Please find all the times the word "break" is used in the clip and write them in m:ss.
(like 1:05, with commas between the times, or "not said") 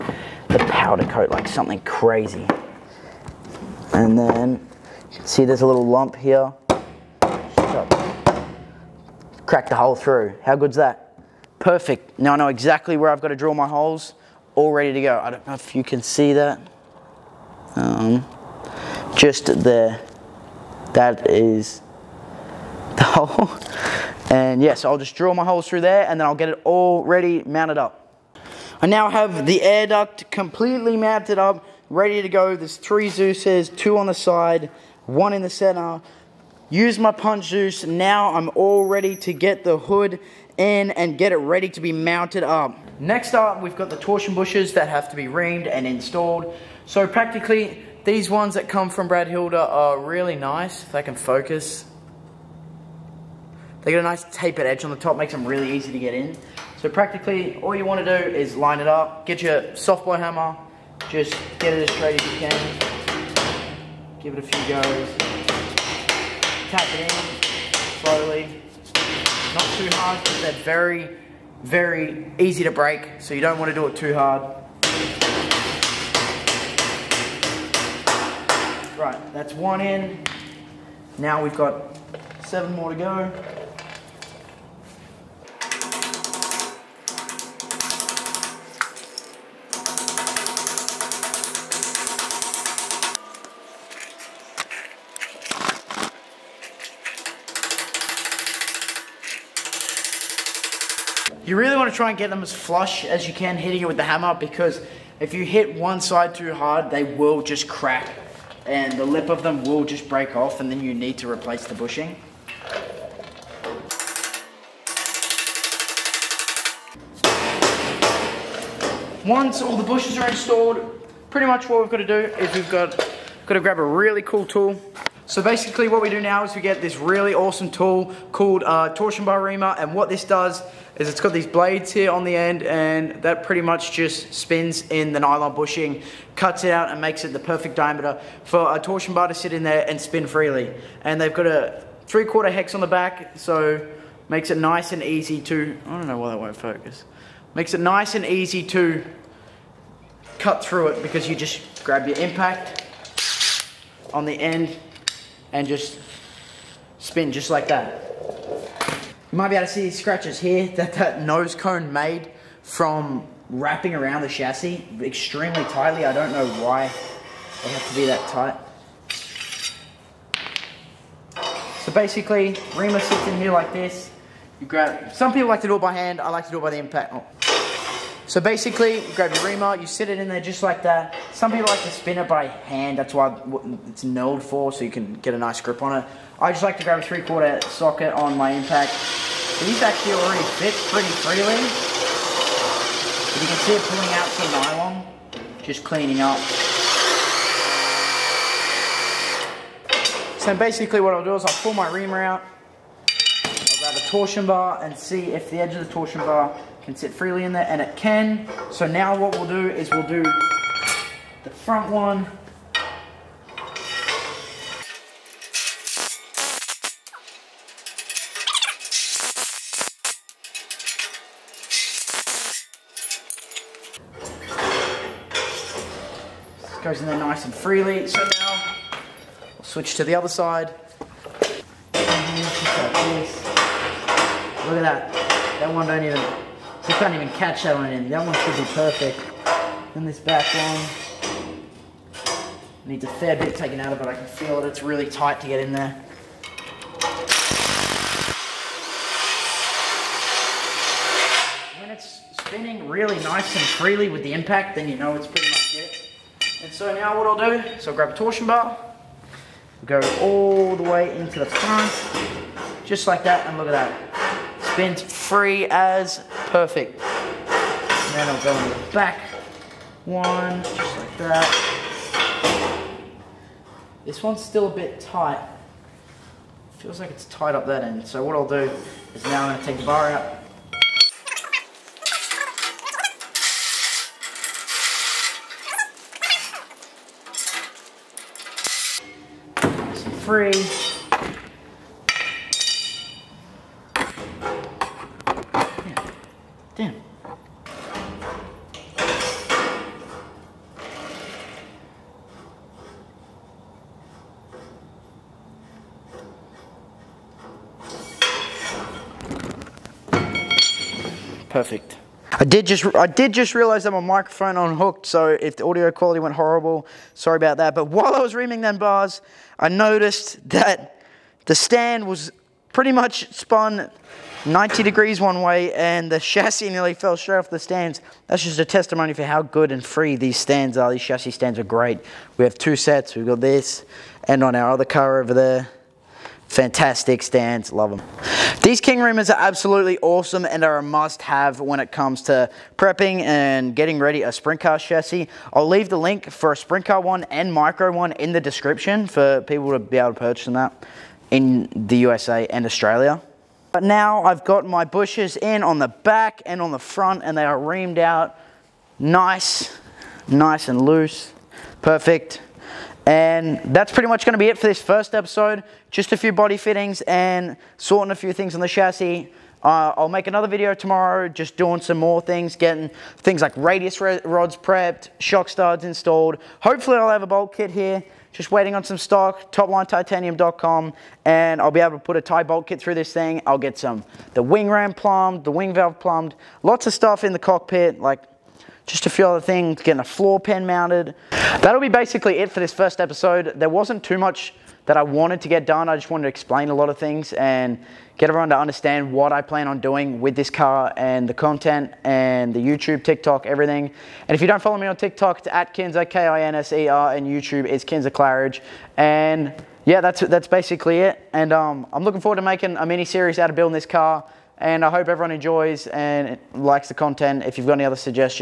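1:12, 1:50.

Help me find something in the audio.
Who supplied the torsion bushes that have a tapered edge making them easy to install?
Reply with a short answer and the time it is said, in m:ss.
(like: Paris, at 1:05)
Brad Hilder, at 0:49.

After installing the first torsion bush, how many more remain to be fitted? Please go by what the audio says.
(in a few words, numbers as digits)
7.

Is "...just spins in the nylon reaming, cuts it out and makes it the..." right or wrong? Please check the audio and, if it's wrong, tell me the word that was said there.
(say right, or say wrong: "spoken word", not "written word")
wrong: "bushing", not "reaming".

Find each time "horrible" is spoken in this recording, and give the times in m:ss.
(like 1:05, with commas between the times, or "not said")
5:16.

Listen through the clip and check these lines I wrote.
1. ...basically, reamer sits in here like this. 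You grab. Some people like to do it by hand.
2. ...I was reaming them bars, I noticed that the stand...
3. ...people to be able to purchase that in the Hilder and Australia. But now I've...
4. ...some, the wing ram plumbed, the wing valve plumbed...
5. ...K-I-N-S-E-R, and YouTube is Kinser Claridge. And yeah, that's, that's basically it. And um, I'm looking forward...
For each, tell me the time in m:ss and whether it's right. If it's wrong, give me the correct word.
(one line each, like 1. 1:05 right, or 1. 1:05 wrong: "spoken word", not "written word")
1. 2:51 right
2. 5:18 right
3. 5:49 wrong: "USA", not "Hilder"
4. 6:23 right
5. 6:46 right.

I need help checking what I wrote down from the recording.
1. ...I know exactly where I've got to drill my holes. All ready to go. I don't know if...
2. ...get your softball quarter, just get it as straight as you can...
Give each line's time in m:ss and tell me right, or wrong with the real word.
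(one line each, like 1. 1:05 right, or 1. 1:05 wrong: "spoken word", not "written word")
1. 0:12 right
2. 0:59 wrong: "hammer", not "quarter".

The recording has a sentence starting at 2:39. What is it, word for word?
You might be able to see these scratches here that that nose cone made from wrapping around the chassis extremely tightly.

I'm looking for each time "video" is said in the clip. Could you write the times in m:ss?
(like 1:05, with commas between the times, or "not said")
6:10.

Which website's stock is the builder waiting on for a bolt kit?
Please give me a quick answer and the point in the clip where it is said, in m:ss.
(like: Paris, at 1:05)
toplinetitanium.com, at 6:19.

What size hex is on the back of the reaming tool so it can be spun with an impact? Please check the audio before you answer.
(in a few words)
three quarter.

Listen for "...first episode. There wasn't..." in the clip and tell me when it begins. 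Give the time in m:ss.
6:32.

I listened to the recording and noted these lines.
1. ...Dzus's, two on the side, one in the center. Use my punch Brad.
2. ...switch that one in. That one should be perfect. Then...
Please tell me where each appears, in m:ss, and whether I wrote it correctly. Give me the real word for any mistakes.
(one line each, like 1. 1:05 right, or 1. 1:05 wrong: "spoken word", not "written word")
1. 0:33 wrong: "Dzus", not "Brad"
2. 3:57 wrong: "catch", not "switch".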